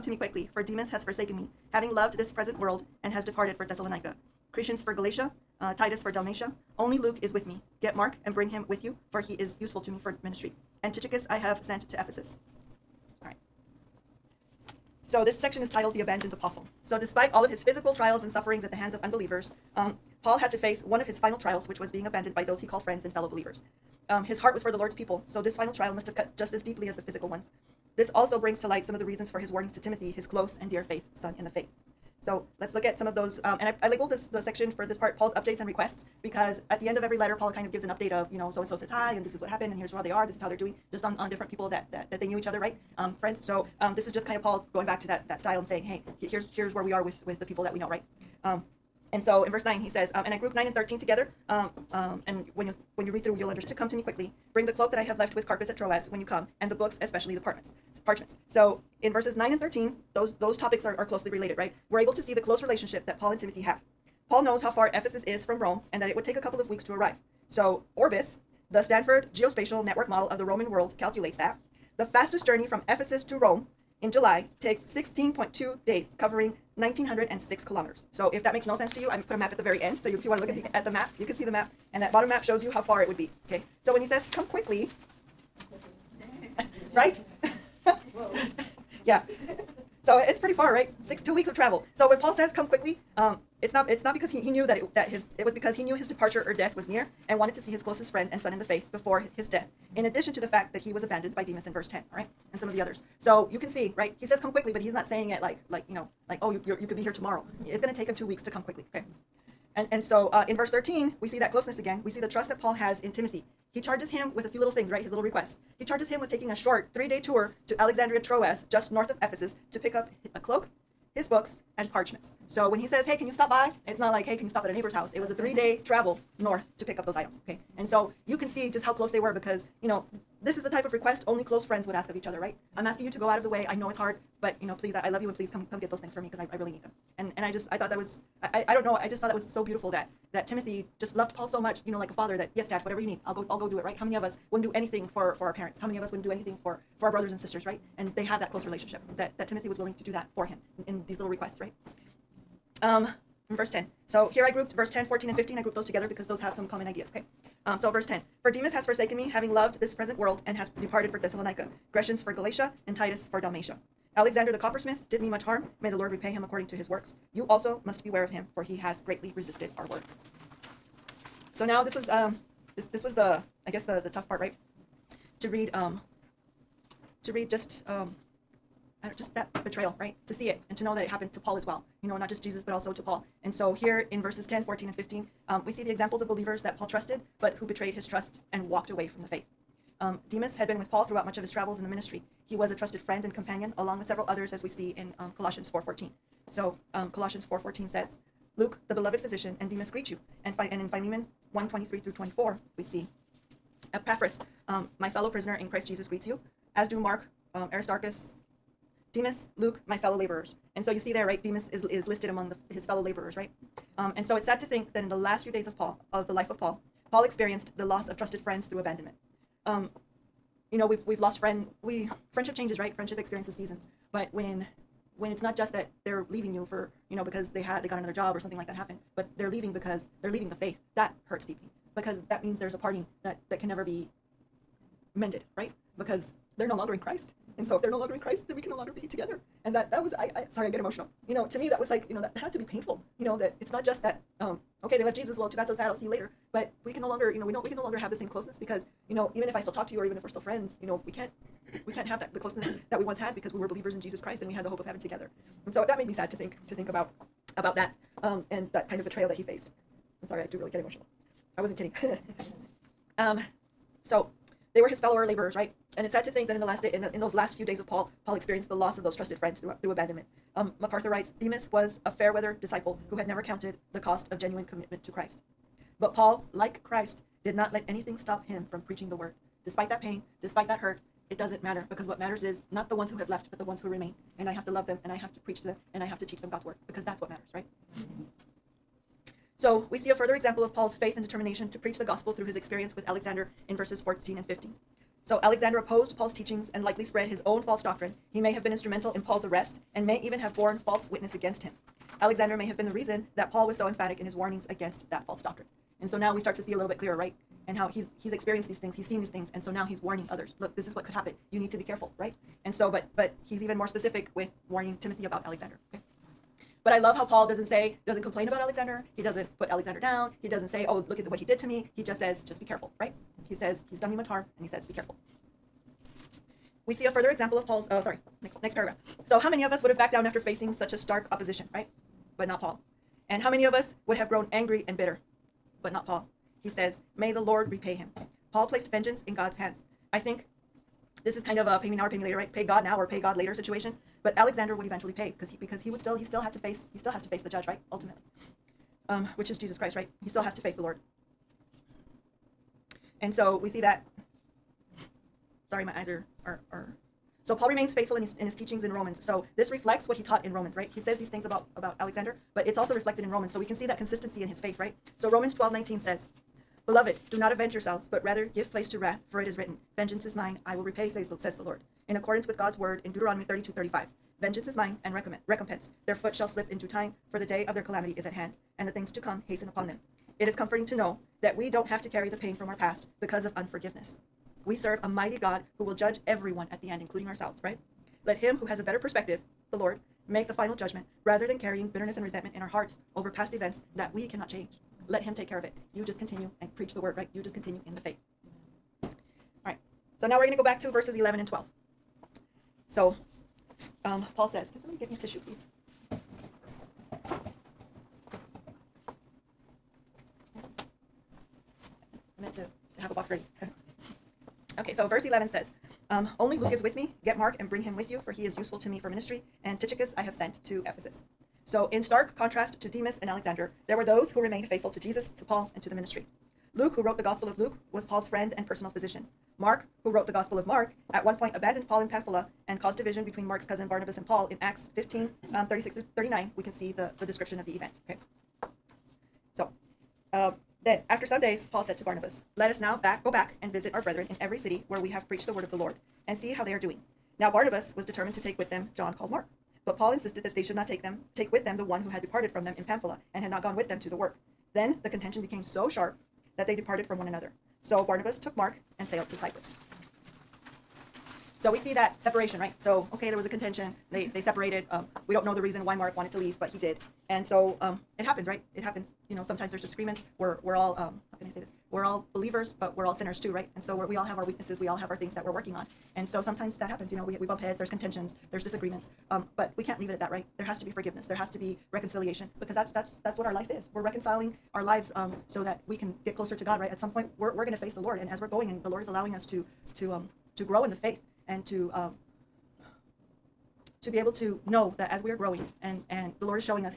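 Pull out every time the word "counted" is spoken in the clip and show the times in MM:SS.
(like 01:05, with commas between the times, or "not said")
04:33.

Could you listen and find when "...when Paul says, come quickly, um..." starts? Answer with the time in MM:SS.
01:32.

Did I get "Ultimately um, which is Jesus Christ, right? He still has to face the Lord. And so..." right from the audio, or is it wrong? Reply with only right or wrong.
right.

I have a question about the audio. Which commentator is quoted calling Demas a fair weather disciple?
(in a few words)
MacArthur.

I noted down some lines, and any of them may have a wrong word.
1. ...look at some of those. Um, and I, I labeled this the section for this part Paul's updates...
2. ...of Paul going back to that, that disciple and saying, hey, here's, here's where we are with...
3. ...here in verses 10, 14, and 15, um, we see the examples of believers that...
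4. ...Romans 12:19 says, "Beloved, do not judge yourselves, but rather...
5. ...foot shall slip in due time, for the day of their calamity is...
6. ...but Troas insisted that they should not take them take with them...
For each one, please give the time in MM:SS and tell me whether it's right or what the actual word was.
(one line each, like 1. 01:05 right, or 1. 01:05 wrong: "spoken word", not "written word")
1. 00:32 right
2. 00:44 wrong: "style", not "disciple"
3. 03:03 right
4. 06:05 wrong: "avenge", not "judge"
5. 06:16 right
6. 07:29 wrong: "Paul", not "Troas".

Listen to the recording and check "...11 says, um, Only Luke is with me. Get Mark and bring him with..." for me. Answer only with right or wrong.
right.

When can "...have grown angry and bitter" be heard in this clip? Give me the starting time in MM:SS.
05:34.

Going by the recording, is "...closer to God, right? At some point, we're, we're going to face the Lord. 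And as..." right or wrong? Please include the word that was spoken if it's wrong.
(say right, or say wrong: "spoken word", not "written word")
right.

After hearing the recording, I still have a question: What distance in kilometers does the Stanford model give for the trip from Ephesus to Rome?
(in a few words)
1,906 kilometers.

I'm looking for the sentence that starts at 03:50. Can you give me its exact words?
That hurts deeply because that means there's a parting that that can never be mended, right?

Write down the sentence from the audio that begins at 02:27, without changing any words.
And they have that close relationship that that Timothy was willing to do that for him in, in these little requests, right?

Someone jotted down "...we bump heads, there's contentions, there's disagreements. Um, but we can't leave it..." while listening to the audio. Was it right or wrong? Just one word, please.
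right.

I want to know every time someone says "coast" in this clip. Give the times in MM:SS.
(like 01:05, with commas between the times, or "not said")
not said.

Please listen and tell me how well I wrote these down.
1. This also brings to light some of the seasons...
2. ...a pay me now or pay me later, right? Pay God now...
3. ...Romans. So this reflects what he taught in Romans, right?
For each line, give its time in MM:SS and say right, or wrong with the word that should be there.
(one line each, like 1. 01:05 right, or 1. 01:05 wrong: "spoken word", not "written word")
1. 00:27 wrong: "reasons", not "seasons"
2. 05:41 right
3. 05:58 right.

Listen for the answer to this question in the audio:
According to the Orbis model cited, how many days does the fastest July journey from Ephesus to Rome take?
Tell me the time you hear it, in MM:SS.
01:14.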